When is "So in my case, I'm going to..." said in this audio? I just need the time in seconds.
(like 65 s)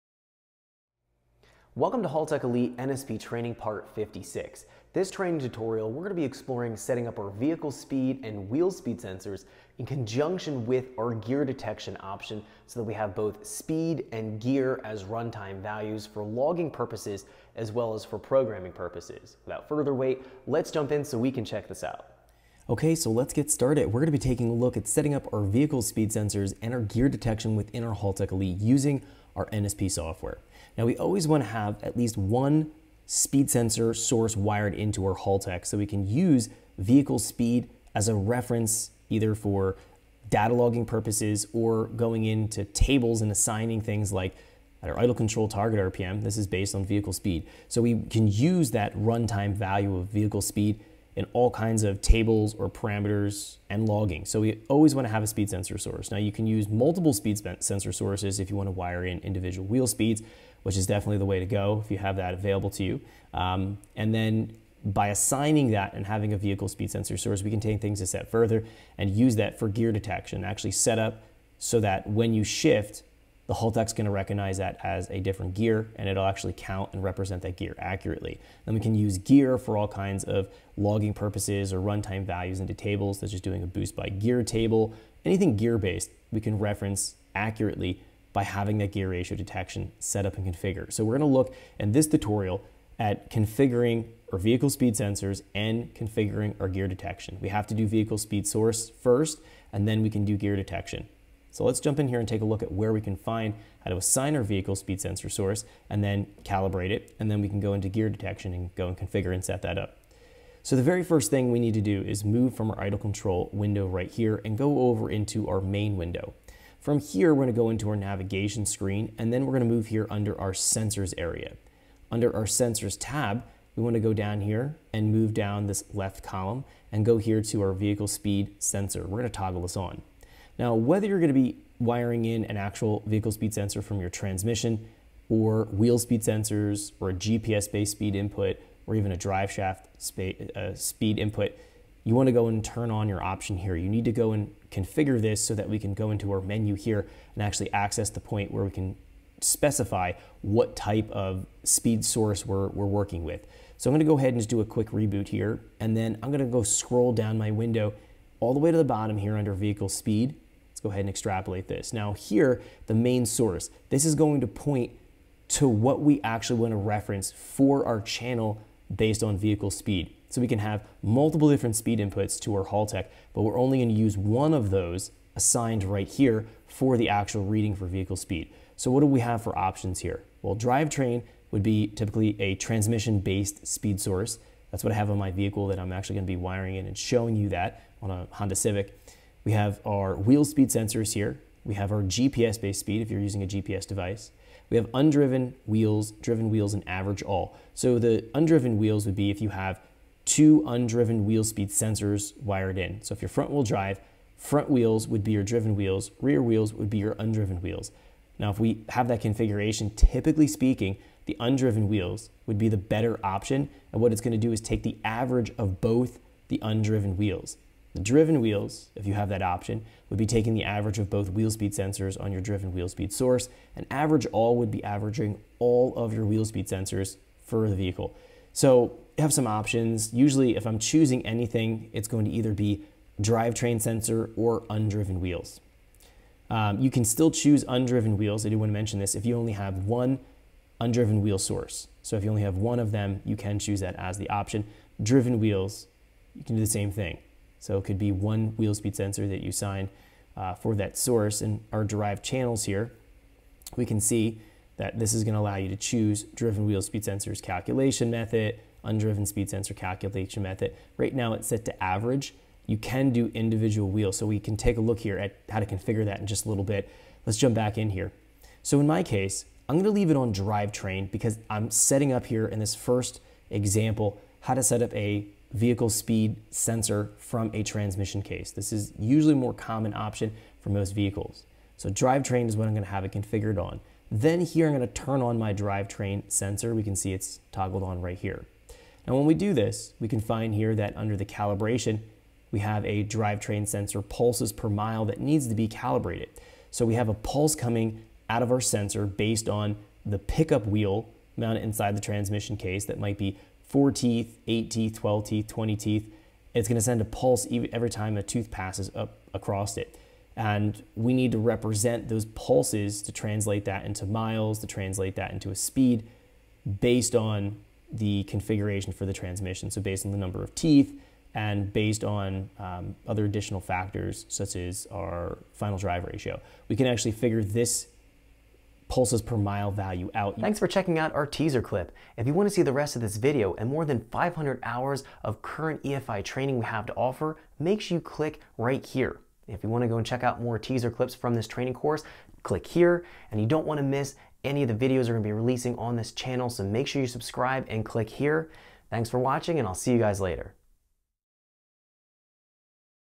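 268 s.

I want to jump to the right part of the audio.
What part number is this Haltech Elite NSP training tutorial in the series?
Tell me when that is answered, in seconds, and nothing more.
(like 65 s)
3 s.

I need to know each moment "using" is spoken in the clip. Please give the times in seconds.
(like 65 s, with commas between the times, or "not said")
28 s, 193 s.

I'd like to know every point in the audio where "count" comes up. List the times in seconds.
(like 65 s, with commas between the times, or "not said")
76 s.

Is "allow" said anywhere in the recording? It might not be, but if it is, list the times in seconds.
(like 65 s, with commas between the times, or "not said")
255 s.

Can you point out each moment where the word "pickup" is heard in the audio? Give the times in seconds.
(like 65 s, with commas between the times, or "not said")
300 s.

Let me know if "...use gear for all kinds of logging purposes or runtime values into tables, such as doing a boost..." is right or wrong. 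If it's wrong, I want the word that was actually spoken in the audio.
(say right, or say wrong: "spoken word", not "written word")
right.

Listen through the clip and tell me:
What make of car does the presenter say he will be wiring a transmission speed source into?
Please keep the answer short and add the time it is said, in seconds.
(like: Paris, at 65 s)
Honda Civic, at 188 s.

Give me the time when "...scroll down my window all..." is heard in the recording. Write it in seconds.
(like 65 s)
156 s.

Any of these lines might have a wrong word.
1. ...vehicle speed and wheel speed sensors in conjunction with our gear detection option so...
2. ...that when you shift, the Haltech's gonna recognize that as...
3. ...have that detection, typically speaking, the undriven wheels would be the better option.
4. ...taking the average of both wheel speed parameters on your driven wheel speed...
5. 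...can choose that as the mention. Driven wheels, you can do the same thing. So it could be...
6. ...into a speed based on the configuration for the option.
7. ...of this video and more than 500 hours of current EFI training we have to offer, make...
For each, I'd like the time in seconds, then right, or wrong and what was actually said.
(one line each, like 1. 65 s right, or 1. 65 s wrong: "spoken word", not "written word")
1. 7 s right
2. 71 s right
3. 208 s wrong: "configuration", not "detection"
4. 220 s wrong: "sensors", not "parameters"
5. 243 s wrong: "option", not "mention"
6. 315 s wrong: "transmission", not "option"
7. 332 s right.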